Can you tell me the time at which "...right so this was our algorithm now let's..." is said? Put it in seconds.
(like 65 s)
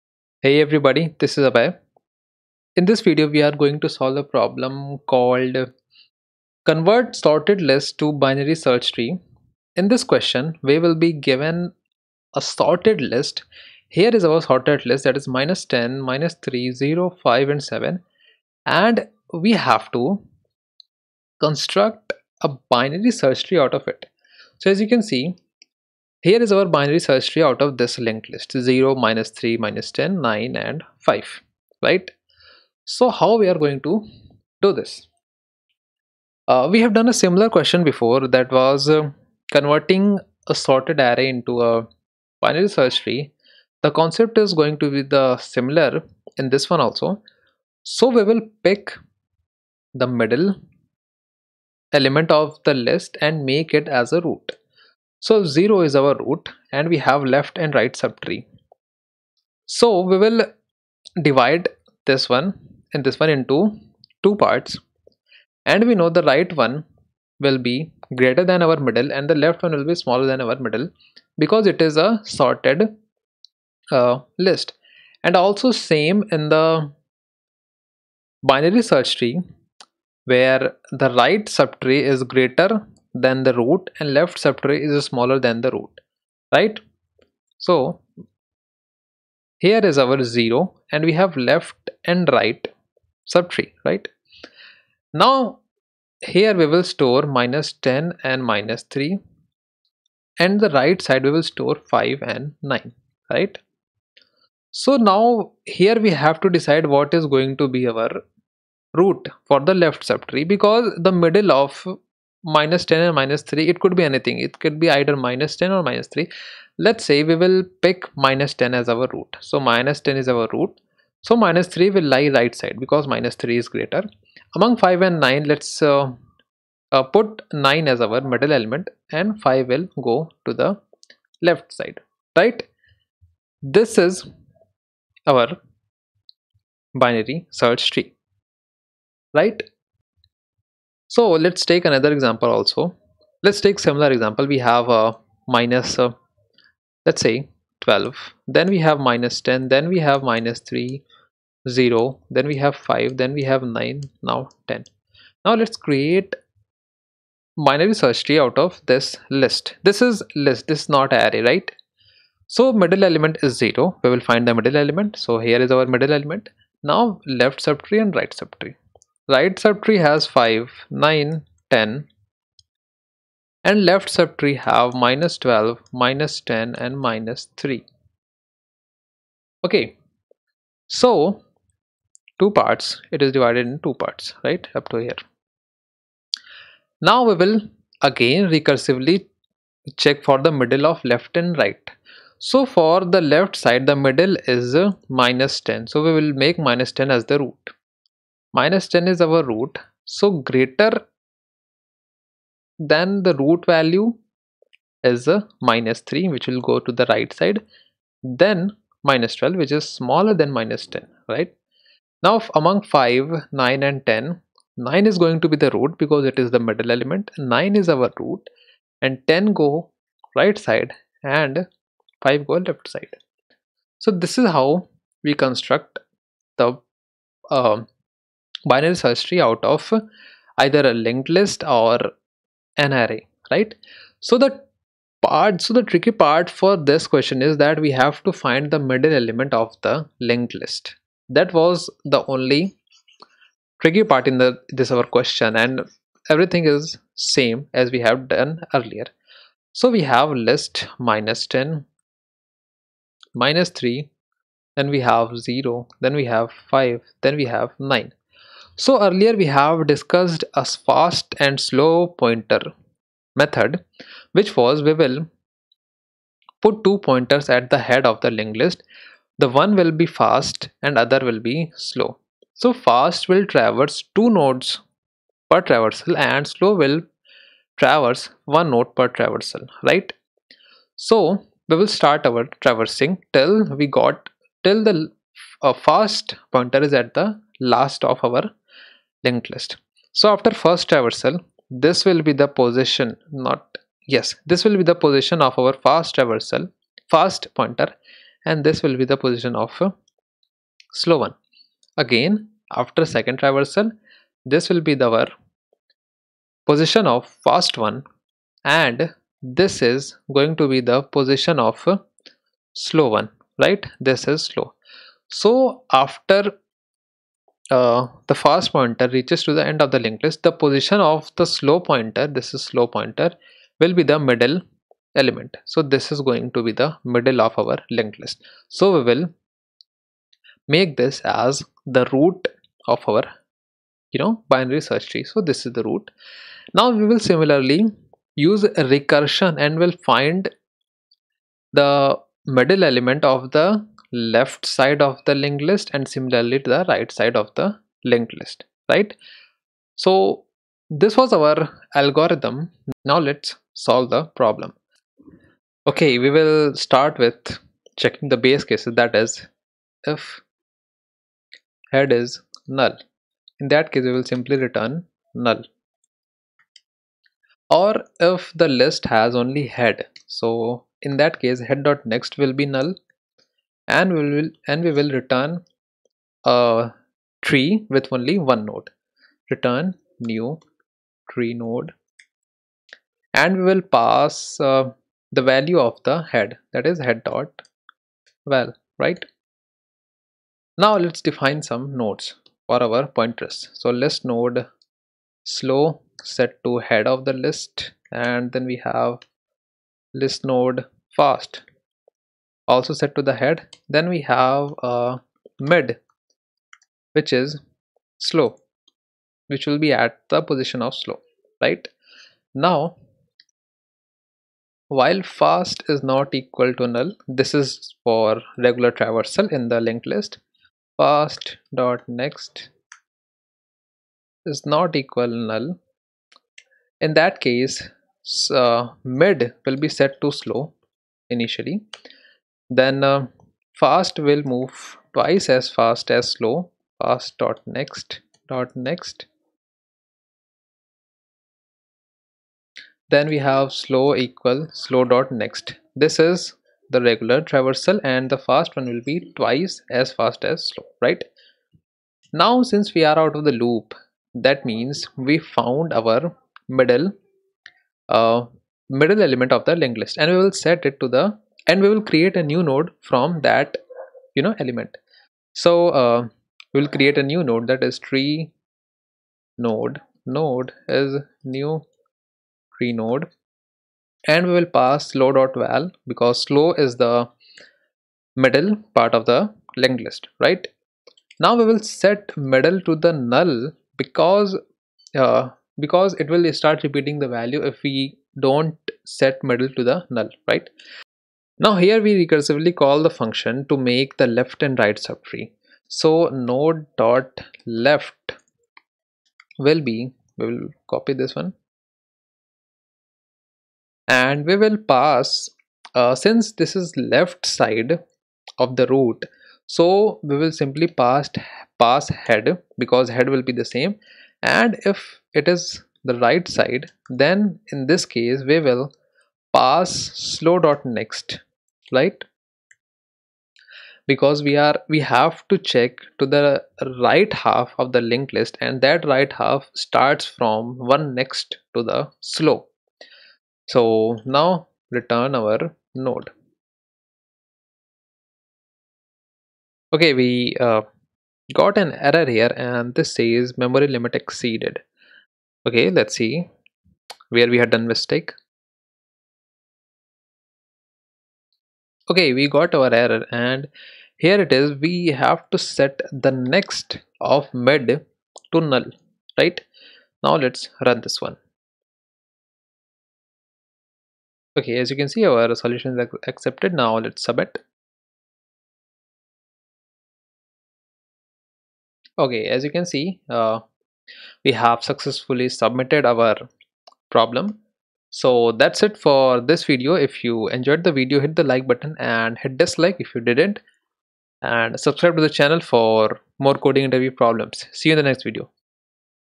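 348 s.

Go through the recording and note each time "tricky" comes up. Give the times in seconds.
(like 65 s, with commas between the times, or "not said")
235 s, 243 s.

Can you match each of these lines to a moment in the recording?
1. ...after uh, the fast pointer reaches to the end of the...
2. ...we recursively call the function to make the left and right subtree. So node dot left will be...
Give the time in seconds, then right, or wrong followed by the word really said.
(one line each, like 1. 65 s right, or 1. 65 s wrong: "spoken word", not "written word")
1. 315 s right
2. 492 s right.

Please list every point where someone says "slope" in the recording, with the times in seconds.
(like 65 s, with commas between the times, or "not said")
532 s.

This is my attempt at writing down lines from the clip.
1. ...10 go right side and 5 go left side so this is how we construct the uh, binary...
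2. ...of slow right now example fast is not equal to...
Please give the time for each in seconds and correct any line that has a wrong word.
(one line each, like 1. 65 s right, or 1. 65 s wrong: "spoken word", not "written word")
1. 219 s right
2. 410 s wrong: "while", not "example".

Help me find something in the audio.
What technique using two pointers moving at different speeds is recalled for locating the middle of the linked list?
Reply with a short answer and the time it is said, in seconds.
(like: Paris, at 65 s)
fast and slow pointer, at 260 s.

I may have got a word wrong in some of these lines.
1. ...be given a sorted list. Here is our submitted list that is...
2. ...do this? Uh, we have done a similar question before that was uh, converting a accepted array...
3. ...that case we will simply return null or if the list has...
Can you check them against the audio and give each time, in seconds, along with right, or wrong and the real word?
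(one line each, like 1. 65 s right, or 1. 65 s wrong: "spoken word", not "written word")
1. 10 s wrong: "sorted", not "submitted"
2. 34 s wrong: "sorted", not "accepted"
3. 363 s right.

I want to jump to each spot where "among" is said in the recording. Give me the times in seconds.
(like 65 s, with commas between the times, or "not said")
124 s, 212 s.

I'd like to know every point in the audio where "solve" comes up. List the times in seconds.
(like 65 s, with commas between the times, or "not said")
3 s, 353 s.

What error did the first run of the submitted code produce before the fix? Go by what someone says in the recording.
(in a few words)
memory limit exceeded.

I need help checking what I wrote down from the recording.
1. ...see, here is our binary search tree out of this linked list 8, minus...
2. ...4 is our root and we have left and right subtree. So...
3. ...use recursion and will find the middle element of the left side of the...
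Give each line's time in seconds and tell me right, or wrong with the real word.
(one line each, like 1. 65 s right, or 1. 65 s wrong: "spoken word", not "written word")
1. 25 s wrong: "0", not "8"
2. 55 s wrong: "0", not "4"
3. 338 s right.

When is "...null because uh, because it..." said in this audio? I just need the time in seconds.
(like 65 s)
483 s.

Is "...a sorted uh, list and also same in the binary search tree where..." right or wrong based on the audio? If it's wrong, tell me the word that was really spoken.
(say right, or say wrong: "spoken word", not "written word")
right.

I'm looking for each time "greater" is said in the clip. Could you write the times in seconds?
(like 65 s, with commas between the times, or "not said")
68 s, 82 s, 123 s, 200 s.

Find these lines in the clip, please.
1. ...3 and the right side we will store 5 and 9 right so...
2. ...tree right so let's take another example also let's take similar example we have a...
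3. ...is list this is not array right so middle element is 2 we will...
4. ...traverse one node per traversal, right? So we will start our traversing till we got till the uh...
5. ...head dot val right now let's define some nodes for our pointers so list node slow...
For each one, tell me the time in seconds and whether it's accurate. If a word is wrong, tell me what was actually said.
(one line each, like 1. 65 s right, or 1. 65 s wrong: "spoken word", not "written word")
1. 98 s right
2. 137 s right
3. 160 s wrong: "0", not "2"
4. 277 s right
5. 387 s right.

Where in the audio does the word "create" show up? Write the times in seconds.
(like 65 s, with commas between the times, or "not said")
155 s, 462 s, 466 s.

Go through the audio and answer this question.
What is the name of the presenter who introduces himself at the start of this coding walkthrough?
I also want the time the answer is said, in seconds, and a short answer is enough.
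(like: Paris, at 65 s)
Abhay, at 1 s.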